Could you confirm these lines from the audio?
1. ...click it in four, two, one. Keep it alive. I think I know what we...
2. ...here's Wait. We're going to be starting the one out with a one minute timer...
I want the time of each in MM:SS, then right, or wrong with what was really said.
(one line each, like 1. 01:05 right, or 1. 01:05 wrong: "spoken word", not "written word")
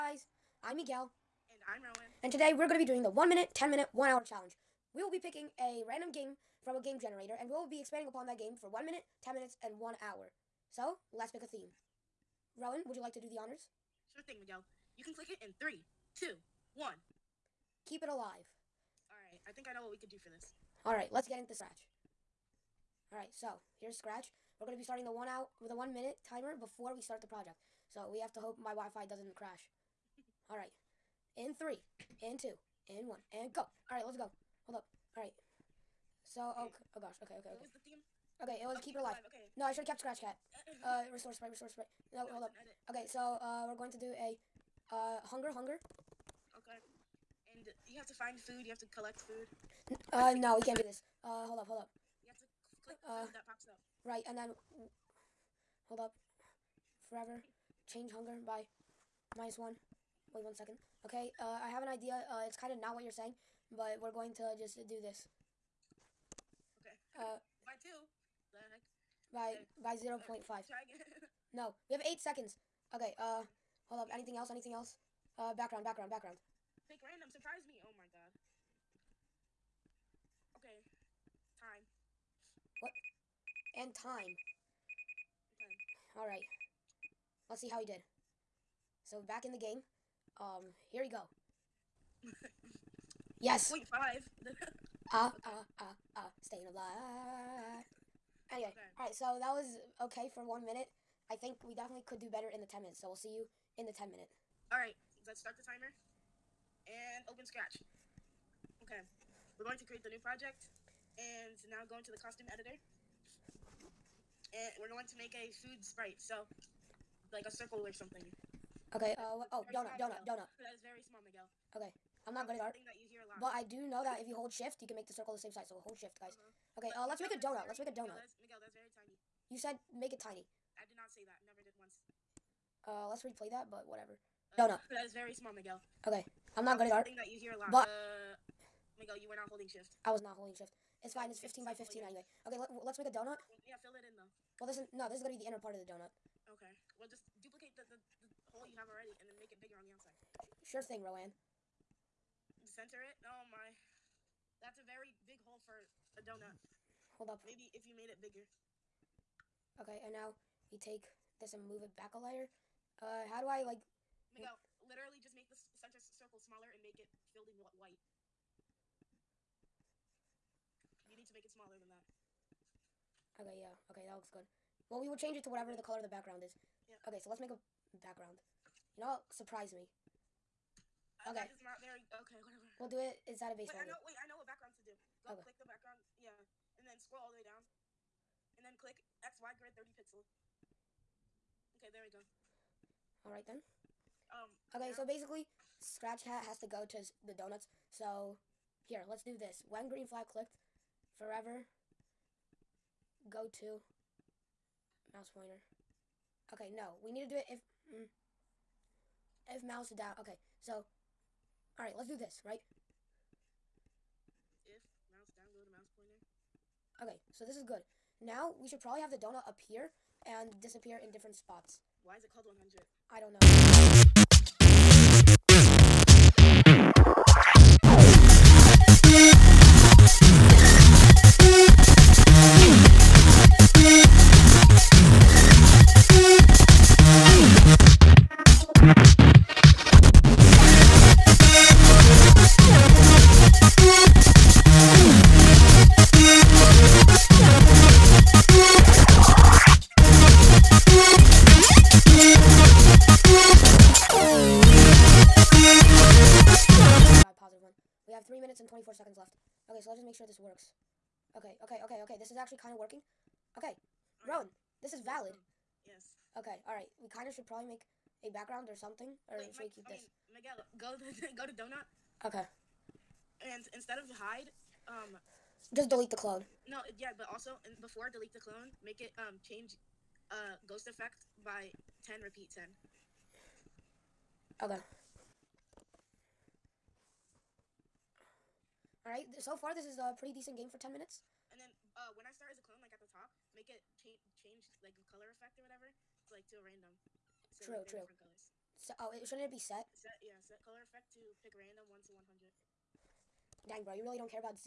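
1. 00:15 wrong: "three", not "four"
2. 00:23 wrong: "Scratch", not "Wait".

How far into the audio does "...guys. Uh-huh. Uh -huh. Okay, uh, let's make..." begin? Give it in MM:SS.
02:06.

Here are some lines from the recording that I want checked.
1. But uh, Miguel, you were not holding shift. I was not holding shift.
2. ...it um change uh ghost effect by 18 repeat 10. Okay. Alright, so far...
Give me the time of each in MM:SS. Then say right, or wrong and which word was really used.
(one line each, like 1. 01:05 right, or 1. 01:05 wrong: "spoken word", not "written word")
1. 02:17 right
2. 04:38 wrong: "10", not "18".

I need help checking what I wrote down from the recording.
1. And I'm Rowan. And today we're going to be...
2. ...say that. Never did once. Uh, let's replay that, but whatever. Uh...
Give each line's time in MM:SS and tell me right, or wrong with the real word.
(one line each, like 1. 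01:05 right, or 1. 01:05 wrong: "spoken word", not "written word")
1. 00:01 right
2. 02:11 right.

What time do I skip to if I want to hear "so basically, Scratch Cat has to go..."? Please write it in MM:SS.
03:14.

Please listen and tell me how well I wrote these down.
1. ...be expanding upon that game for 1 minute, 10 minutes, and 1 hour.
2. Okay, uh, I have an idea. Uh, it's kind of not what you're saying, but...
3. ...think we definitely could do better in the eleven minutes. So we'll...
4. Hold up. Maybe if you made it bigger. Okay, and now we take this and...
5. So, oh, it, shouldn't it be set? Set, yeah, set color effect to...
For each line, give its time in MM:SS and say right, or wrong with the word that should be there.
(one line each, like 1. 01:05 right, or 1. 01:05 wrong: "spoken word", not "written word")
1. 00:07 right
2. 01:01 right
3. 01:41 wrong: "ten", not "eleven"
4. 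02:37 right
5. 04:58 right.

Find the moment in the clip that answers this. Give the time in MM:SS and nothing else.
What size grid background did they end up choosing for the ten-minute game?
03:09.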